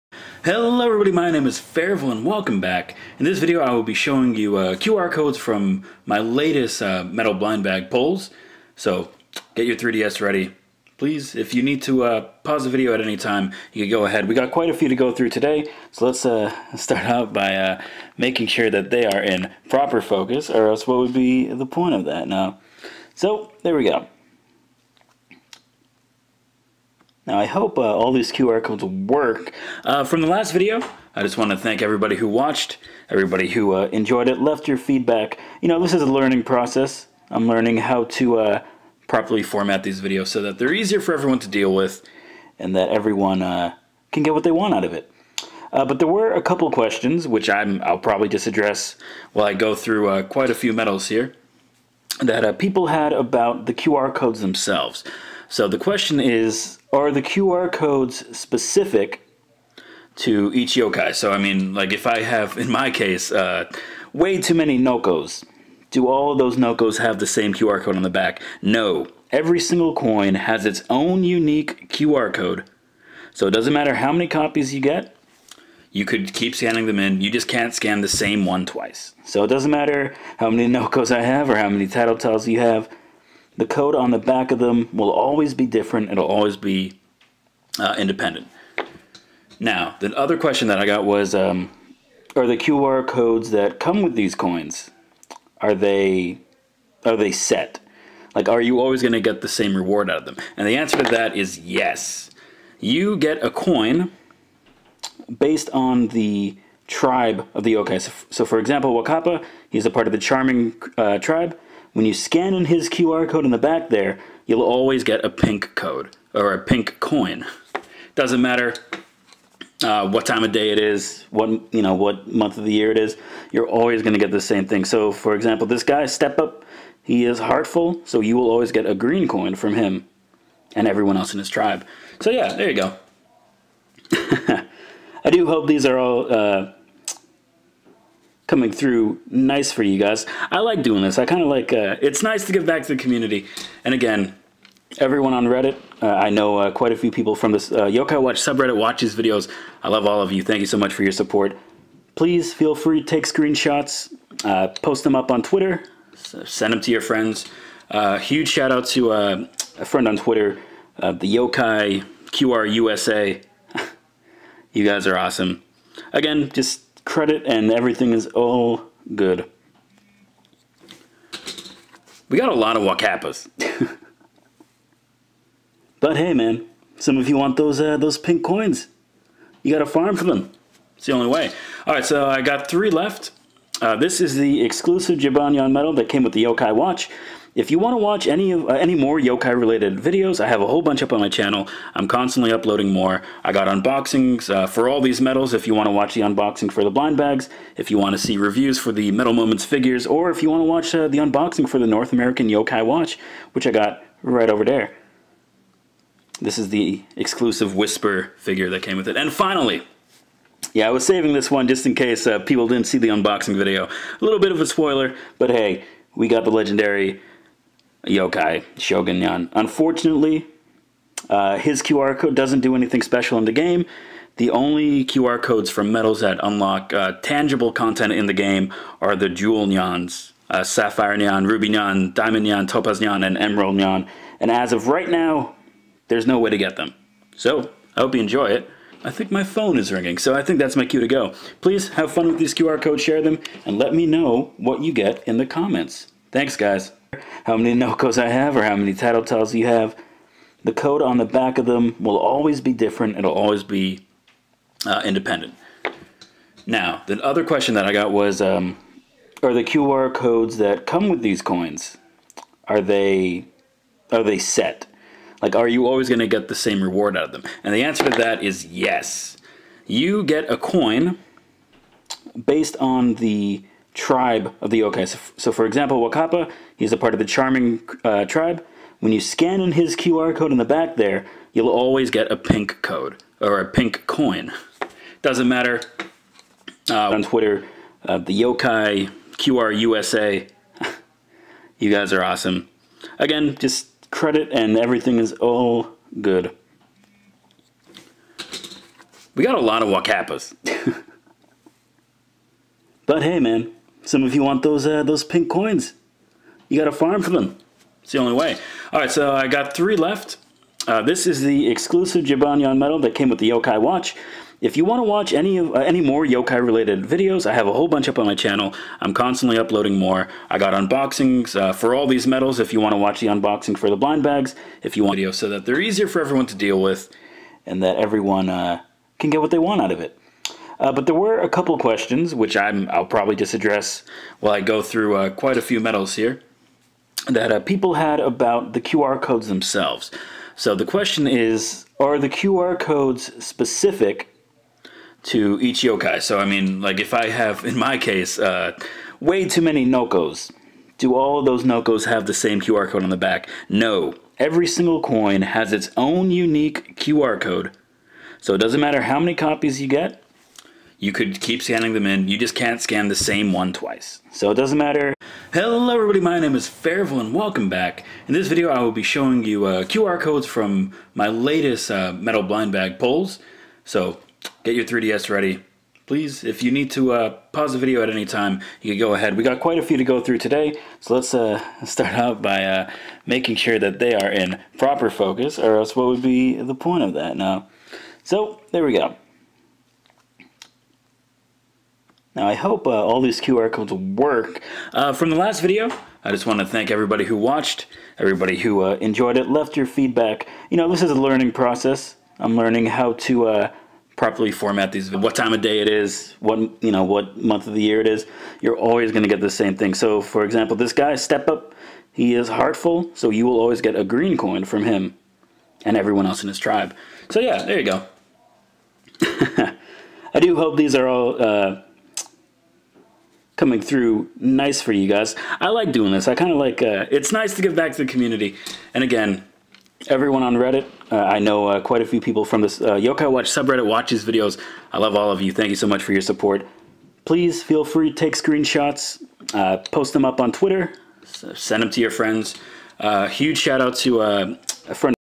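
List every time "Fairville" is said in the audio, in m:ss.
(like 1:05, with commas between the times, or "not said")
0:01, 6:06.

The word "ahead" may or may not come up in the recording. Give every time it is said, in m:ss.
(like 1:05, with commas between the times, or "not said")
0:14, 6:19.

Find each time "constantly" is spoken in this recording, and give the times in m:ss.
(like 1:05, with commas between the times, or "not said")
3:12, 5:19.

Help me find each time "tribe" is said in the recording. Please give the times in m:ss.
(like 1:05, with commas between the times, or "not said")
1:46, 1:51, 2:11, 4:33, 4:38, 6:56.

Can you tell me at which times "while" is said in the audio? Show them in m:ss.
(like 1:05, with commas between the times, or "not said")
0:49, 5:34.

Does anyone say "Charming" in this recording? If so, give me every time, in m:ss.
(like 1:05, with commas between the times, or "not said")
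1:50, 4:37.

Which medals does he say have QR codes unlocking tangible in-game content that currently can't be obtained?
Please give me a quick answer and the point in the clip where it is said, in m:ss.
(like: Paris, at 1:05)
Jewel Nyans, at 3:49.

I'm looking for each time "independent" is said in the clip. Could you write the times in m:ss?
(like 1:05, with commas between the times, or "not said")
1:27, 4:15.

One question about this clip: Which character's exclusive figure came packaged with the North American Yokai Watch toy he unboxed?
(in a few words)
Whisper.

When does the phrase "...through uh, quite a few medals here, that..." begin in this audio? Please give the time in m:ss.
5:34.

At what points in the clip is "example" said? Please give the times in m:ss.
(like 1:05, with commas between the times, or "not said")
1:48, 2:05, 4:35, 6:50.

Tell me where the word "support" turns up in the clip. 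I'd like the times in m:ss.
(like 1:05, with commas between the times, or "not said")
2:31, 7:16.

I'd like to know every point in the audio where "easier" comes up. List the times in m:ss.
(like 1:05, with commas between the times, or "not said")
0:40, 5:25.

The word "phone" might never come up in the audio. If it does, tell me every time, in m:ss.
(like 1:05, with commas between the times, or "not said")
3:59.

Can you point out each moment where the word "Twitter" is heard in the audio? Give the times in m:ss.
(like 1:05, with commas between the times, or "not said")
2:35, 2:40, 4:47, 7:20.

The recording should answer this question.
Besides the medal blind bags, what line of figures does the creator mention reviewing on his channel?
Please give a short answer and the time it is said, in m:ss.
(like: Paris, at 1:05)
Medal Moments, at 3:19.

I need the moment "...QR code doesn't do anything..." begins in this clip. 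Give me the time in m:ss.
3:41.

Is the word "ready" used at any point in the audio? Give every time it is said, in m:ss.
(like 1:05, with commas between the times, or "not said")
0:10, 6:15.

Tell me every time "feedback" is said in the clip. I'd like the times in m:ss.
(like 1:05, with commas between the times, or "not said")
0:34, 6:39.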